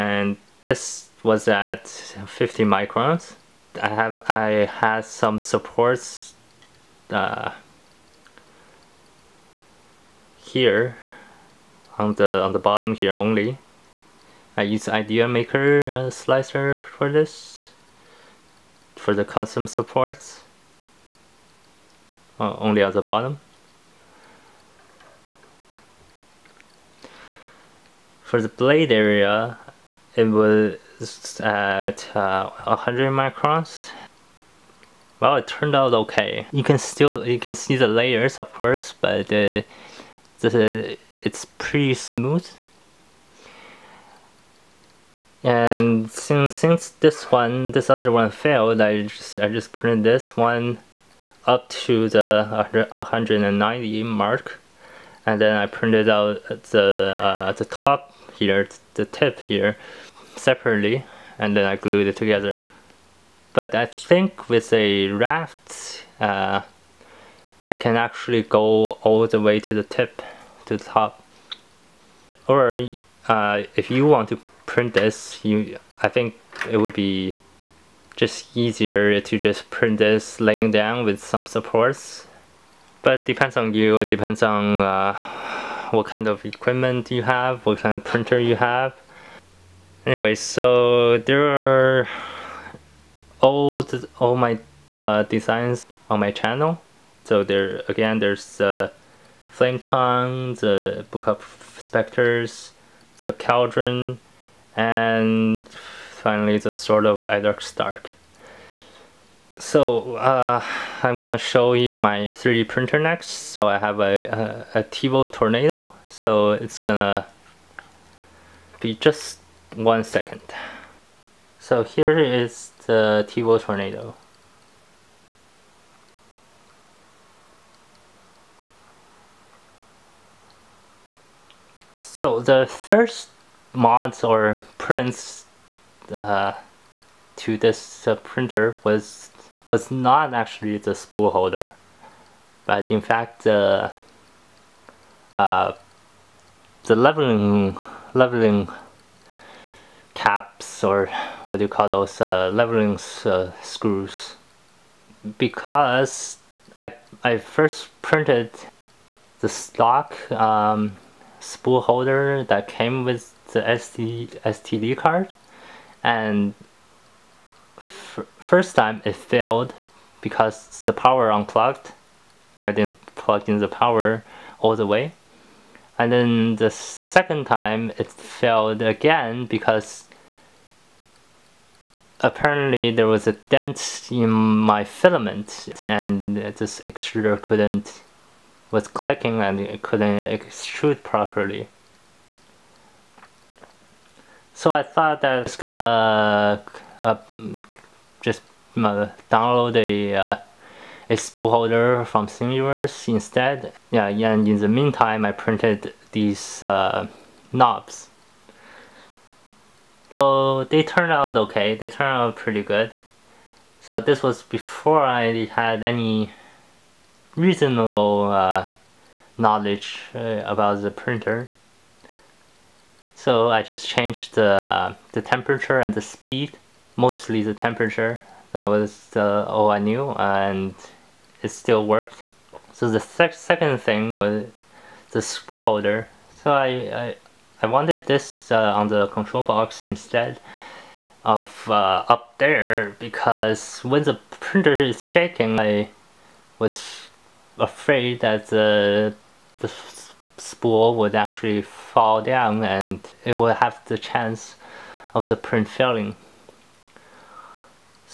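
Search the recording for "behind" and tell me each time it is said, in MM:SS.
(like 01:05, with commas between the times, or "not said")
not said.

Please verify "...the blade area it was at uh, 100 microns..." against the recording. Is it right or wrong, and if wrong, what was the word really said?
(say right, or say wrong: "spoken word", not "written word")
right.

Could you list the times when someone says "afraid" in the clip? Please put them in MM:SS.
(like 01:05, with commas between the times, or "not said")
04:07.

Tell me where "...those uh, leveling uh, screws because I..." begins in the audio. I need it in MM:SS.
02:31.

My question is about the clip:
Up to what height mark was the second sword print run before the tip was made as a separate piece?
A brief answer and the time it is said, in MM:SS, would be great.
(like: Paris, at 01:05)
190, at 00:52.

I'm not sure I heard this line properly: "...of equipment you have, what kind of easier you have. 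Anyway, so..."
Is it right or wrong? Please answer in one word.
wrong.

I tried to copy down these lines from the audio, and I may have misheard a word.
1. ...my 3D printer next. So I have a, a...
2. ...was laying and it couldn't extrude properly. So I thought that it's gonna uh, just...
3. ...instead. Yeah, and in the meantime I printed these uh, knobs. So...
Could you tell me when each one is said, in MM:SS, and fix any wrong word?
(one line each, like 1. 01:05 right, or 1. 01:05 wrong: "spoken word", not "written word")
1. 01:51 right
2. 03:08 wrong: "clicking", not "laying"
3. 03:23 right.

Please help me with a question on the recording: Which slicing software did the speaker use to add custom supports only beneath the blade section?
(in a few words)
ideaMaker.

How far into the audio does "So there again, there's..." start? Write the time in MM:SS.
01:37.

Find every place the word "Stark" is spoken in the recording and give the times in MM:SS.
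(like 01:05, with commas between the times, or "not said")
01:47.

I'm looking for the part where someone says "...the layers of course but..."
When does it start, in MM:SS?
00:37.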